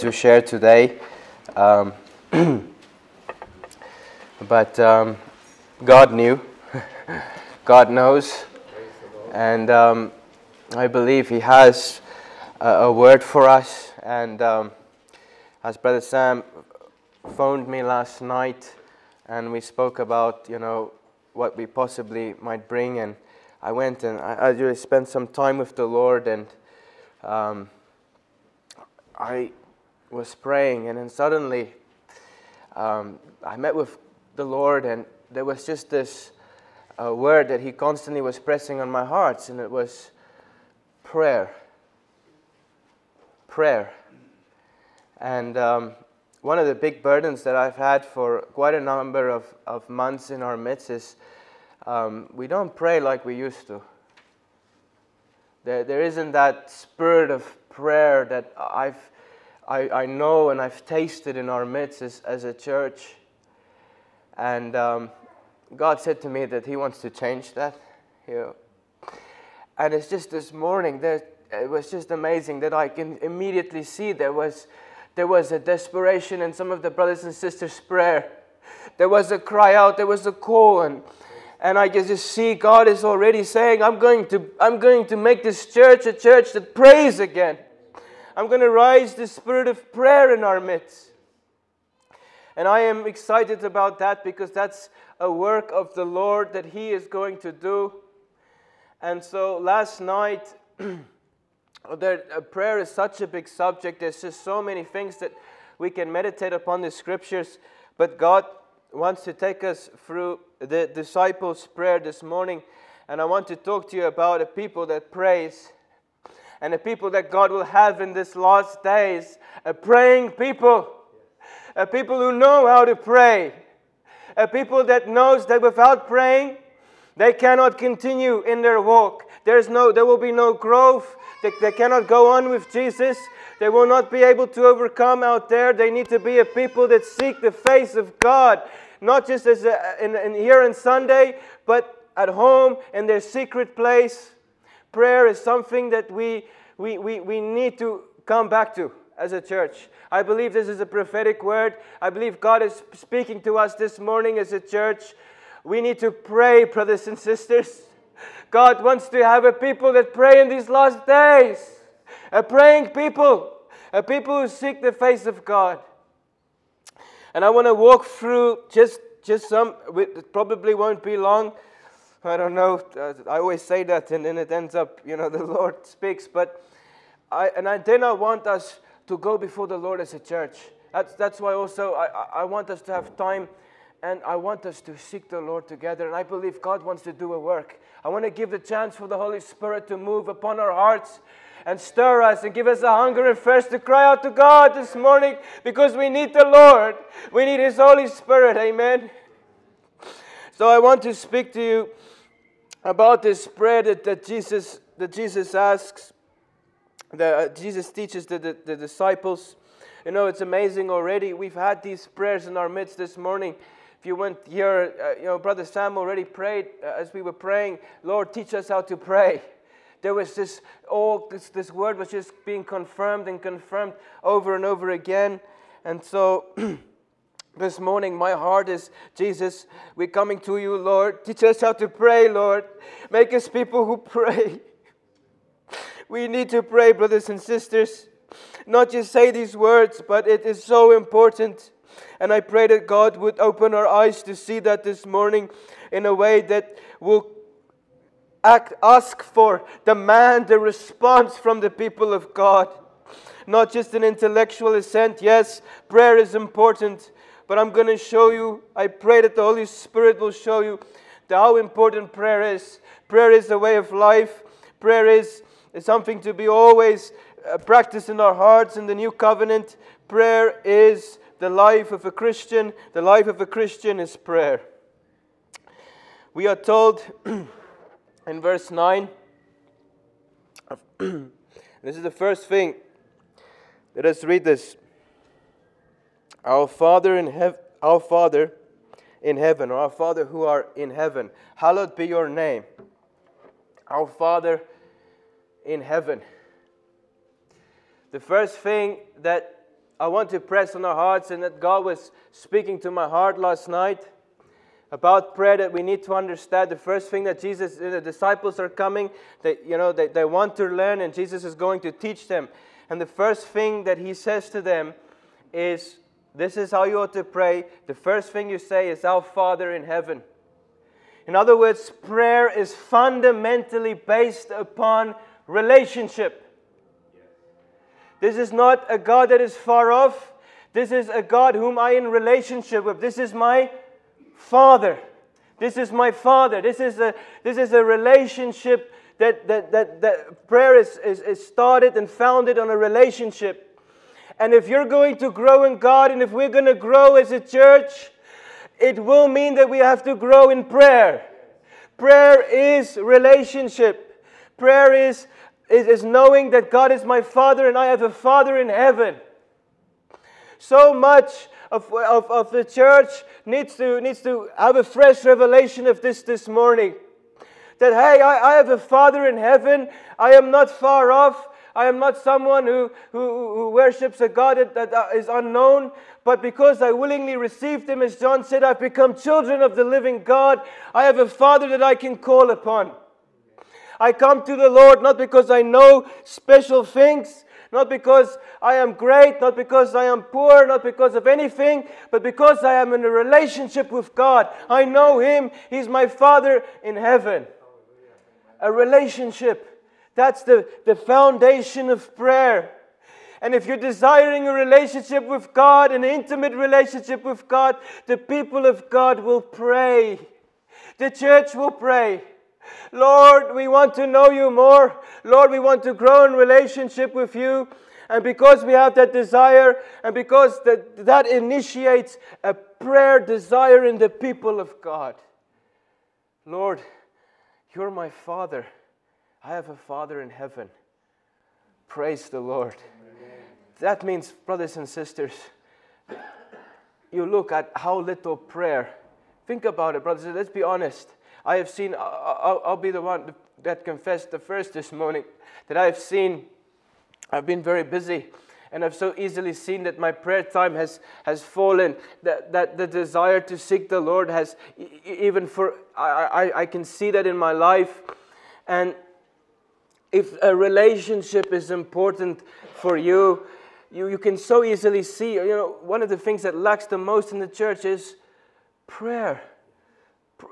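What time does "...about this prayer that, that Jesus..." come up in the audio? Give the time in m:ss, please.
3:22.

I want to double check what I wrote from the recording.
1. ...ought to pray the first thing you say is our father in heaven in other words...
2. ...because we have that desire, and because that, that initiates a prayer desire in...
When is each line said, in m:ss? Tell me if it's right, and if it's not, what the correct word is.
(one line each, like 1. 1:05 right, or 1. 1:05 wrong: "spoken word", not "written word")
1. 5:16 right
2. 6:58 right.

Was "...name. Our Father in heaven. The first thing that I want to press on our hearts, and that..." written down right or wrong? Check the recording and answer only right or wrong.
right.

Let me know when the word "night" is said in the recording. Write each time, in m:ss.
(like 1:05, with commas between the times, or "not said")
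0:18, 1:40, 5:03.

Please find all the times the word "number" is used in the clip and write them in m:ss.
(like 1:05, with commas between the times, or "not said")
0:48.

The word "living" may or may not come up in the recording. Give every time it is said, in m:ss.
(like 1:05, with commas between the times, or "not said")
6:19.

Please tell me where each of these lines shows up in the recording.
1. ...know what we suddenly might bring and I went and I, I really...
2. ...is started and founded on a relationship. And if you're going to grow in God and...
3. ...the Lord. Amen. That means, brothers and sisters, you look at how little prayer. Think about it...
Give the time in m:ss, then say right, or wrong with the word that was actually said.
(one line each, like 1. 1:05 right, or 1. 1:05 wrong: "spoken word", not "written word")
1. 0:20 wrong: "possibly", not "suddenly"
2. 5:41 right
3. 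7:12 right.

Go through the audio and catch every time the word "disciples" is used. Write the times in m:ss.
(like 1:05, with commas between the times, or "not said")
1:50, 3:28, 5:07.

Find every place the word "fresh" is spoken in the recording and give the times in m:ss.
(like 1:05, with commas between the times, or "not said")
6:04.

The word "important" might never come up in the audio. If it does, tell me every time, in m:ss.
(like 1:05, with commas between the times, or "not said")
4:00, 4:16, 4:21, 7:41.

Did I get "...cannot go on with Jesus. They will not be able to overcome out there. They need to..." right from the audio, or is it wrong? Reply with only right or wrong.
right.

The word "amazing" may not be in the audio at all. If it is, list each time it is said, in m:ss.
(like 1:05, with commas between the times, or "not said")
1:12, 3:30.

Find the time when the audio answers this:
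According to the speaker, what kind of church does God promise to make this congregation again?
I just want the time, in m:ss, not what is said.
1:26.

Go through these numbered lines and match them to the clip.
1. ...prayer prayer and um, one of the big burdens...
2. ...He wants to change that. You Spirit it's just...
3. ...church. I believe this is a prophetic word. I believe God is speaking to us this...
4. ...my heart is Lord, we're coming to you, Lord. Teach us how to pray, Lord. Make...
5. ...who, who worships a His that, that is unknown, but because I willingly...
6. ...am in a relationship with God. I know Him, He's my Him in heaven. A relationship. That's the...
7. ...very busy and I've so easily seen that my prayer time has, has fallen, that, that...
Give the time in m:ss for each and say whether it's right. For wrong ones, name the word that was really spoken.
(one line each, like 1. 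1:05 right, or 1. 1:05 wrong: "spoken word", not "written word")
1. 0:41 right
2. 1:06 wrong: "And", not "Spirit"
3. 2:29 right
4. 3:48 wrong: "Jesus", not "Lord"
5. 6:13 wrong: "God", not "His"
6. 6:32 wrong: "Father", not "Him"
7. 7:27 right.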